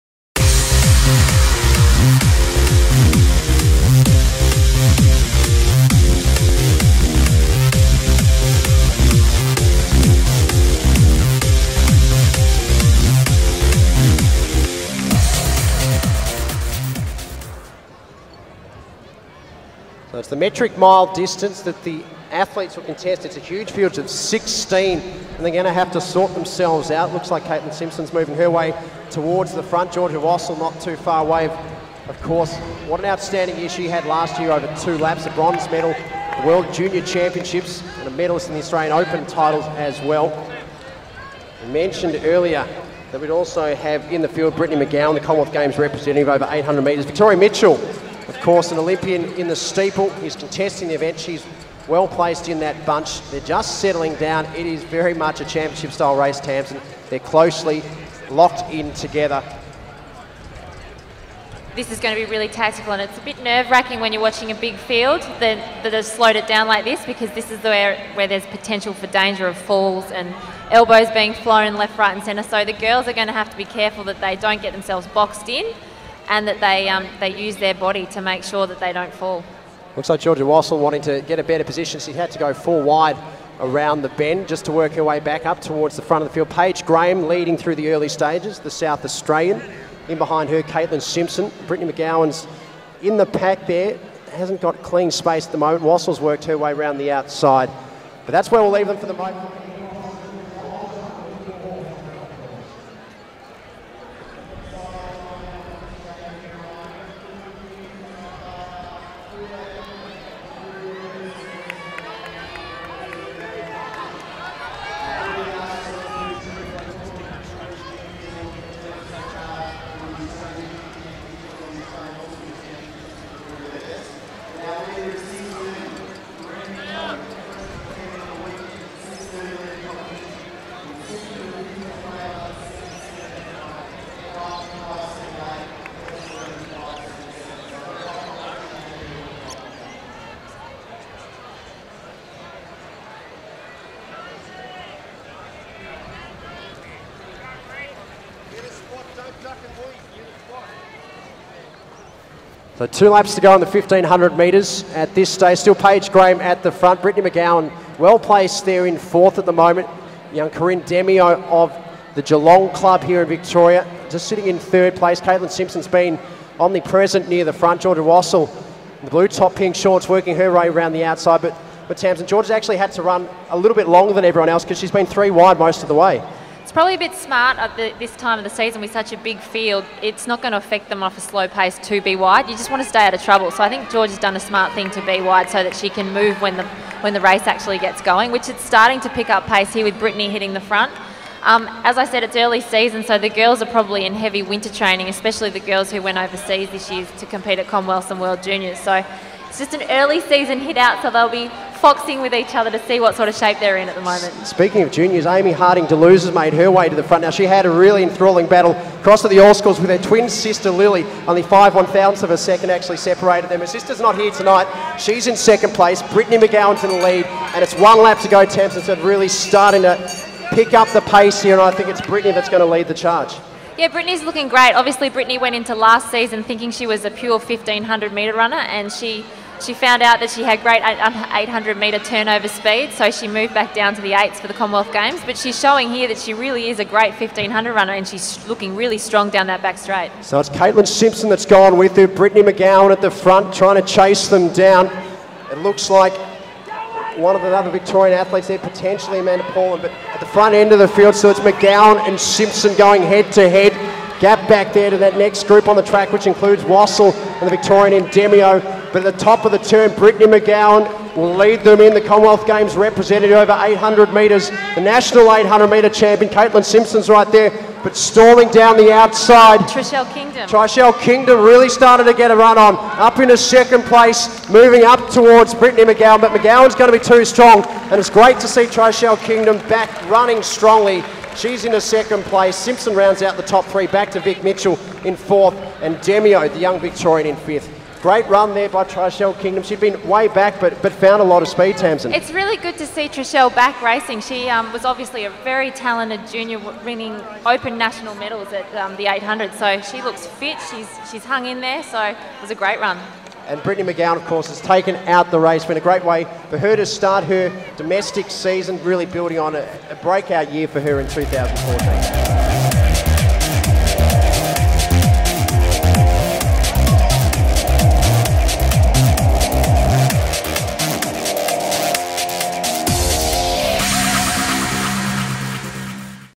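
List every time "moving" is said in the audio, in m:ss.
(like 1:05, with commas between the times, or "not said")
0:28, 4:34.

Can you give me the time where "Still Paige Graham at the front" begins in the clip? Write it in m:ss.
2:35.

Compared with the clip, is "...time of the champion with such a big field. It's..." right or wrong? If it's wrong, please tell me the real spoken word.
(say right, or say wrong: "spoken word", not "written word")
wrong: "season", not "champion".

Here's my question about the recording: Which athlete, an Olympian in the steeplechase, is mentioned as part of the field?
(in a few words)
Victoria Mitchell.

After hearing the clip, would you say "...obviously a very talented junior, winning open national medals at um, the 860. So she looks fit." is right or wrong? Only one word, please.
wrong.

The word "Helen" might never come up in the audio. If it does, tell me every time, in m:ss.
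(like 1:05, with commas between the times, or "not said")
not said.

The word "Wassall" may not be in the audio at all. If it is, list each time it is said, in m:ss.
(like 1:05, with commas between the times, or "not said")
0:30, 1:20, 1:35, 2:48, 4:16.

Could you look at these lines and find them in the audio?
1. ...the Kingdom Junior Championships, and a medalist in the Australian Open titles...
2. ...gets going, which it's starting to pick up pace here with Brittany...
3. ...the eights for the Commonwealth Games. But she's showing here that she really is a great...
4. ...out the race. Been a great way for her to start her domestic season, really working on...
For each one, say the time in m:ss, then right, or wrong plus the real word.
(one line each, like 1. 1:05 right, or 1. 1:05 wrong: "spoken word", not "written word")
1. 0:36 wrong: "World", not "Kingdom"
2. 3:07 right
3. 3:54 right
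4. 5:05 wrong: "building", not "working".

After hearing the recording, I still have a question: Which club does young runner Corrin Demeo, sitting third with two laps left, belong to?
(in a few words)
Geelong Club.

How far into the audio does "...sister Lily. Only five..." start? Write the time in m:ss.
3:30.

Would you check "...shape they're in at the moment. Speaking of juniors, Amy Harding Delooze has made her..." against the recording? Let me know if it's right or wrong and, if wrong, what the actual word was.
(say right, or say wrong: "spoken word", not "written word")
right.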